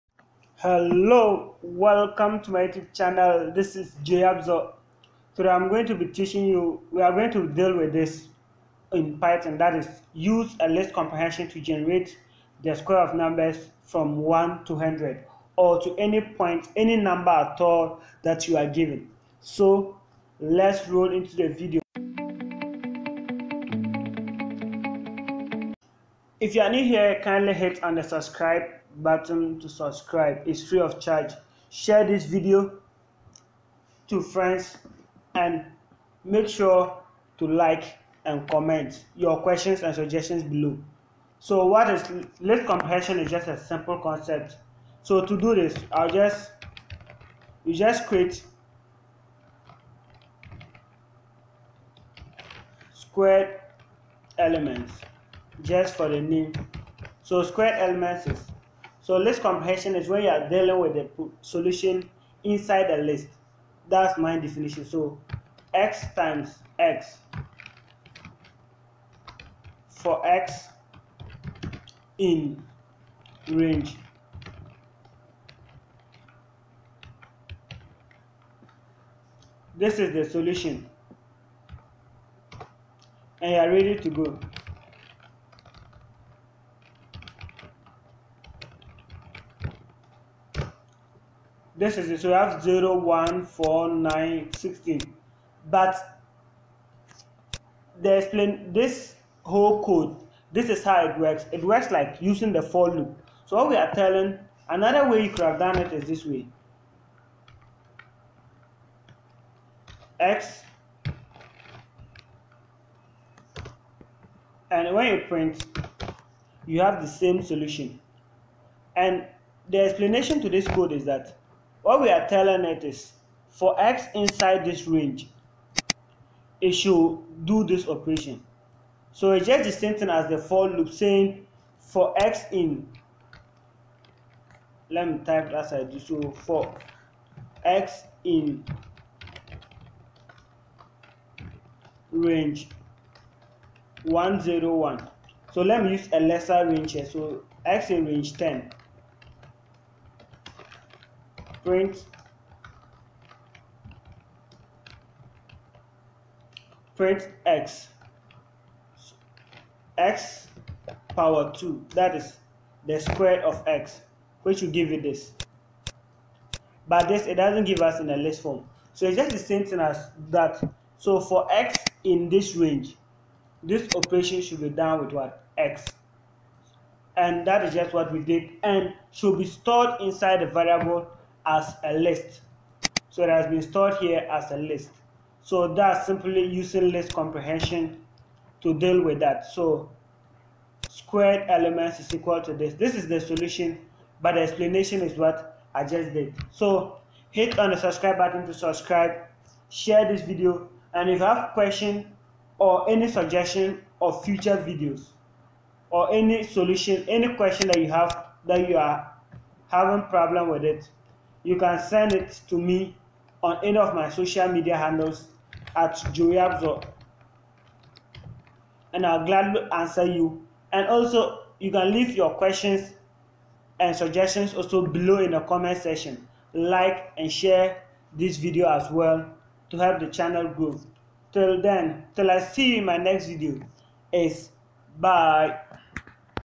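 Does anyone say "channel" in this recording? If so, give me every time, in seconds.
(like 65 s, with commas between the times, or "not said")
2 s, 230 s.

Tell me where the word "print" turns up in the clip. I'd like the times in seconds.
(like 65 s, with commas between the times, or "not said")
115 s, 151 s, 156 s.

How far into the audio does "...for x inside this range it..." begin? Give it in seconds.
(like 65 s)
123 s.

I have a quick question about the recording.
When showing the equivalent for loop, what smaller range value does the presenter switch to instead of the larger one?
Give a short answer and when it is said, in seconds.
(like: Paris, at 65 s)
10, at 148 s.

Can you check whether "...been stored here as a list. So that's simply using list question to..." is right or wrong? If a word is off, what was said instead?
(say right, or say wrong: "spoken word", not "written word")
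wrong: "comprehension", not "question".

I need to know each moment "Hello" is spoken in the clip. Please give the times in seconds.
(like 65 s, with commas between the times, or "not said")
0 s.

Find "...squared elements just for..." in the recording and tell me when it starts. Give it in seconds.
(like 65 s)
52 s.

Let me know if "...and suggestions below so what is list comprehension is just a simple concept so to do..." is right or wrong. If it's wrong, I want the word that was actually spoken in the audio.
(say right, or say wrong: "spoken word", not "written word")
right.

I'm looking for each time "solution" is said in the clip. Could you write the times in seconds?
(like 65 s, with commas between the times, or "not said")
61 s, 80 s, 117 s, 193 s, 206 s.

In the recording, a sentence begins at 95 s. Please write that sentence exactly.
But they explain this whole code.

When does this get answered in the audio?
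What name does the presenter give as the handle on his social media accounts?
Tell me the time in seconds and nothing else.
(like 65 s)
216 s.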